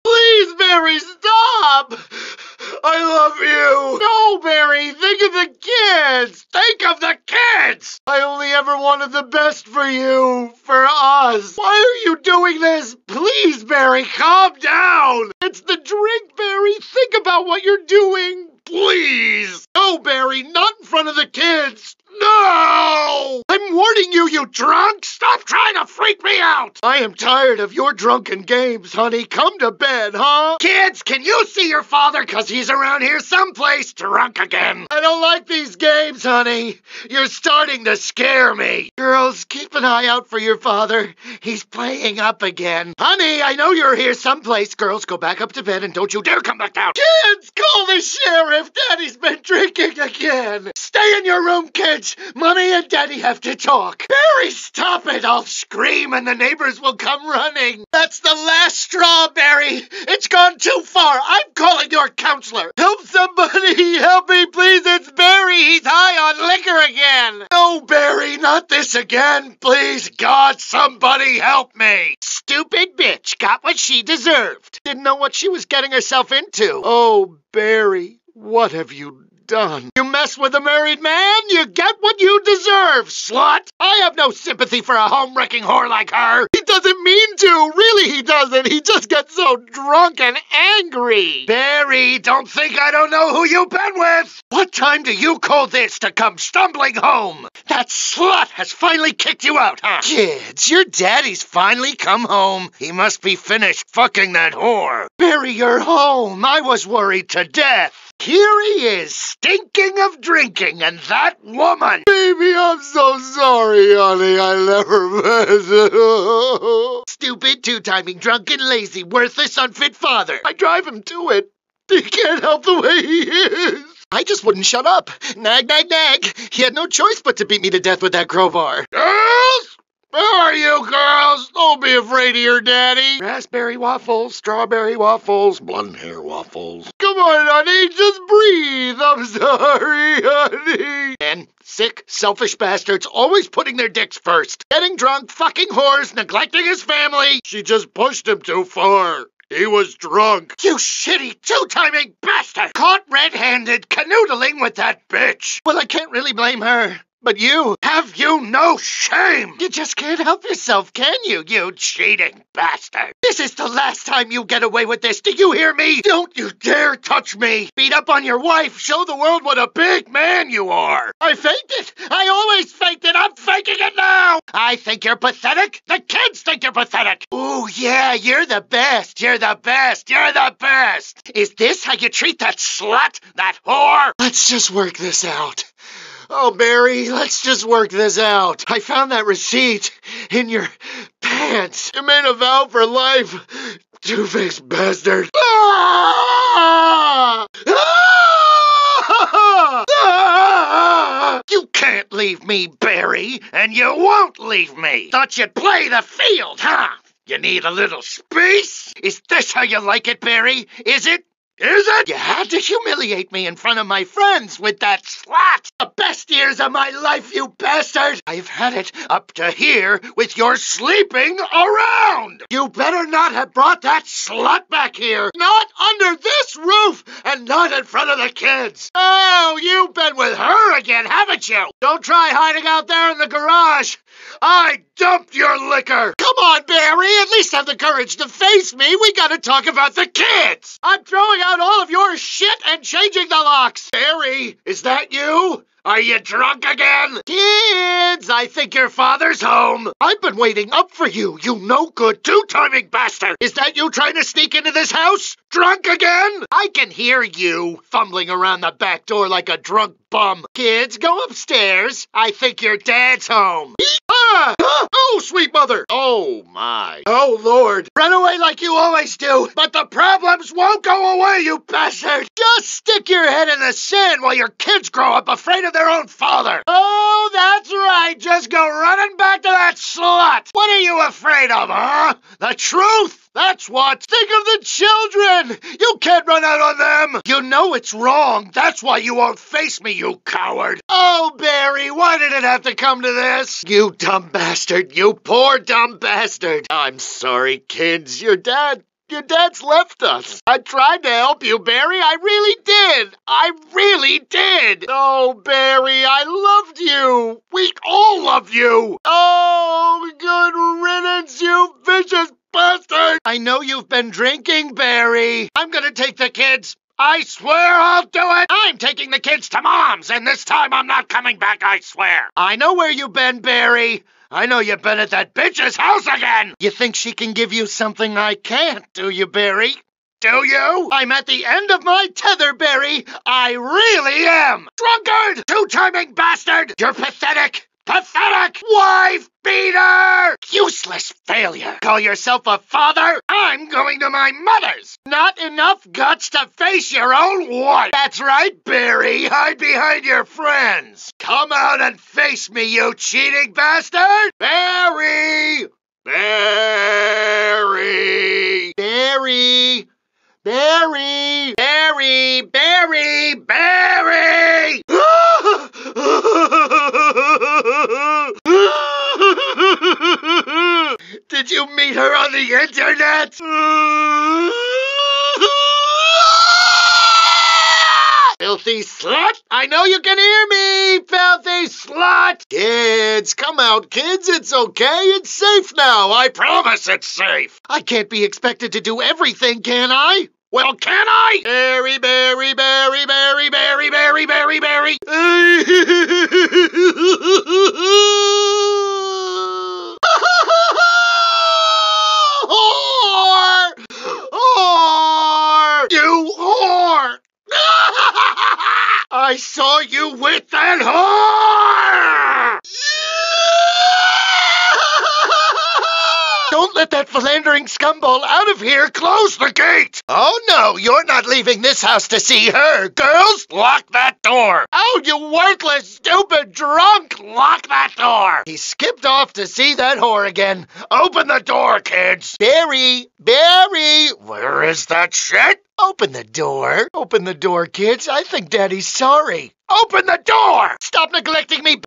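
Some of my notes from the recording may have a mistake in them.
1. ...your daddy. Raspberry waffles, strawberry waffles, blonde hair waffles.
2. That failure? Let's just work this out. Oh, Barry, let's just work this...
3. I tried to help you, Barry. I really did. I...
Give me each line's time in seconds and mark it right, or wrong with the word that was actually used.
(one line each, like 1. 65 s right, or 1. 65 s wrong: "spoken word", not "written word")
1. 132 s right
2. 183 s wrong: "whore", not "failure"
3. 300 s right.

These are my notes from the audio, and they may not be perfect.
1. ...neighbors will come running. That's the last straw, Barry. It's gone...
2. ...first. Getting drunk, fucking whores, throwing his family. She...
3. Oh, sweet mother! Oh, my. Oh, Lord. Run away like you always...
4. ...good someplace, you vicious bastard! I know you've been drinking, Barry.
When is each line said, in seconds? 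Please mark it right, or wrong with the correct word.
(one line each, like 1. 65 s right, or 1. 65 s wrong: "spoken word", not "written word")
1. 56 s right
2. 144 s wrong: "neglecting", not "throwing"
3. 264 s right
4. 310 s wrong: "riddance", not "someplace".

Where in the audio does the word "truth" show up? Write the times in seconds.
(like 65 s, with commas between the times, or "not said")
282 s.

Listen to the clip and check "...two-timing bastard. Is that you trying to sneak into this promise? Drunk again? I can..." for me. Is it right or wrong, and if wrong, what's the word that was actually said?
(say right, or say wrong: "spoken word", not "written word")
wrong: "house", not "promise".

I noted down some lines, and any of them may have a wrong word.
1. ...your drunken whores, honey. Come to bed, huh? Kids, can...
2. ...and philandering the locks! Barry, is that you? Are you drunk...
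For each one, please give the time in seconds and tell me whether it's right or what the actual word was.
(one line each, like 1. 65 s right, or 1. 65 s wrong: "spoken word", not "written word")
1. 27 s wrong: "games", not "whores"
2. 242 s wrong: "changing", not "philandering".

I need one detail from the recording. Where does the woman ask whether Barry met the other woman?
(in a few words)
on the internet.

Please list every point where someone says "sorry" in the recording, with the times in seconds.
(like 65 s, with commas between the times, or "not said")
113 s, 139 s, 296 s, 438 s.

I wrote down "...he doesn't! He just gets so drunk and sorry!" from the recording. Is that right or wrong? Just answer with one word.
wrong.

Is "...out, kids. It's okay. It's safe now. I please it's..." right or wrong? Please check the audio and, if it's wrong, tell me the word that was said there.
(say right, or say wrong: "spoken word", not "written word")
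wrong: "promise", not "please".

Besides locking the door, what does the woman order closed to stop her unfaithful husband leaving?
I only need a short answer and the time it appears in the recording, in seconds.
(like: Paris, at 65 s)
the gate, at 419 s.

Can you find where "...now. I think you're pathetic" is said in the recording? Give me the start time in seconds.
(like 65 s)
173 s.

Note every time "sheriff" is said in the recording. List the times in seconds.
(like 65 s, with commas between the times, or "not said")
47 s.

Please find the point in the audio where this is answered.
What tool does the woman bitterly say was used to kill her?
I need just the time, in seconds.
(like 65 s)
128 s.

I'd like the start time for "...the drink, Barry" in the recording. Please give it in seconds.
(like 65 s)
15 s.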